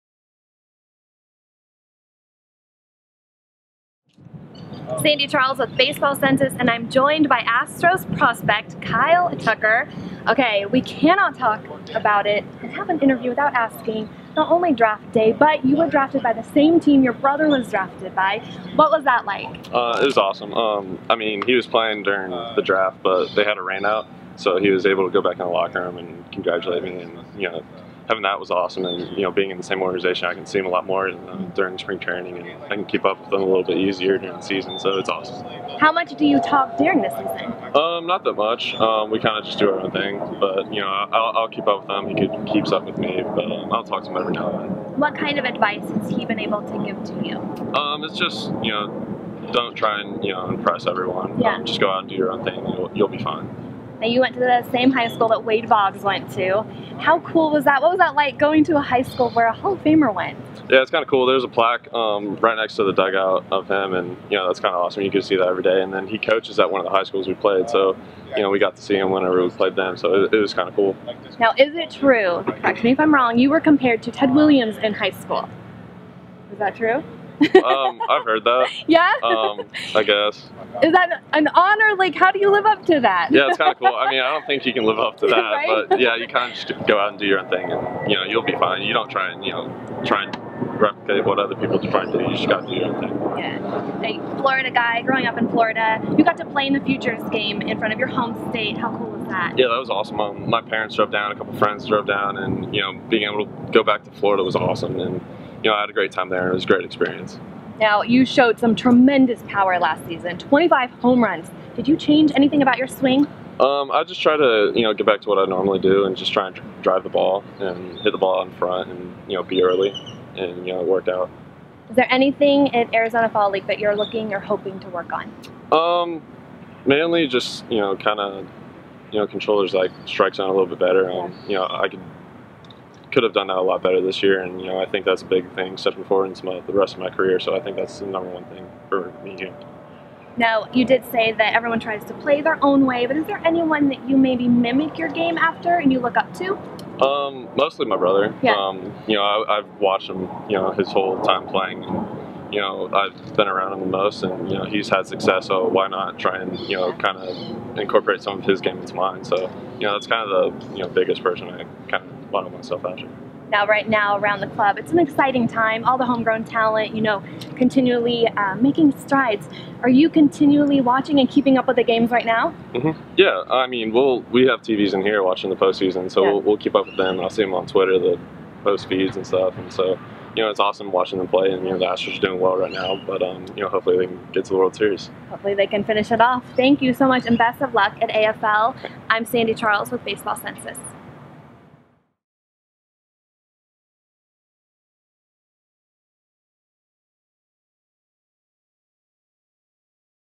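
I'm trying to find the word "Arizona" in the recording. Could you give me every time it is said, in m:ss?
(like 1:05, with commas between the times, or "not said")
2:02.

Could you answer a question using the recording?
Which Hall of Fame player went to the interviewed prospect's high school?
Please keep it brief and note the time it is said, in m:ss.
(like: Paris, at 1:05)
Wade Boggs, at 0:55.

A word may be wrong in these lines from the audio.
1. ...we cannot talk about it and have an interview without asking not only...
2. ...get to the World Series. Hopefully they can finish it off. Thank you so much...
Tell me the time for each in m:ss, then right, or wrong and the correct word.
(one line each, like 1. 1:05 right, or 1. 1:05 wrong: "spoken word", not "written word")
1. 0:10 right
2. 3:04 right.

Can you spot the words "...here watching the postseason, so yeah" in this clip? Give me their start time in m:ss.
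2:55.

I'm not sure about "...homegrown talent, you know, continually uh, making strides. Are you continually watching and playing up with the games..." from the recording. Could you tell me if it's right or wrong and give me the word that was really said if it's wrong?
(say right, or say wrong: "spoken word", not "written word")
wrong: "keeping", not "playing".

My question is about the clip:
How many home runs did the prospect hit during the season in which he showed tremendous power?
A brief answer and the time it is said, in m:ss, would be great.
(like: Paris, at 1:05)
25, at 1:50.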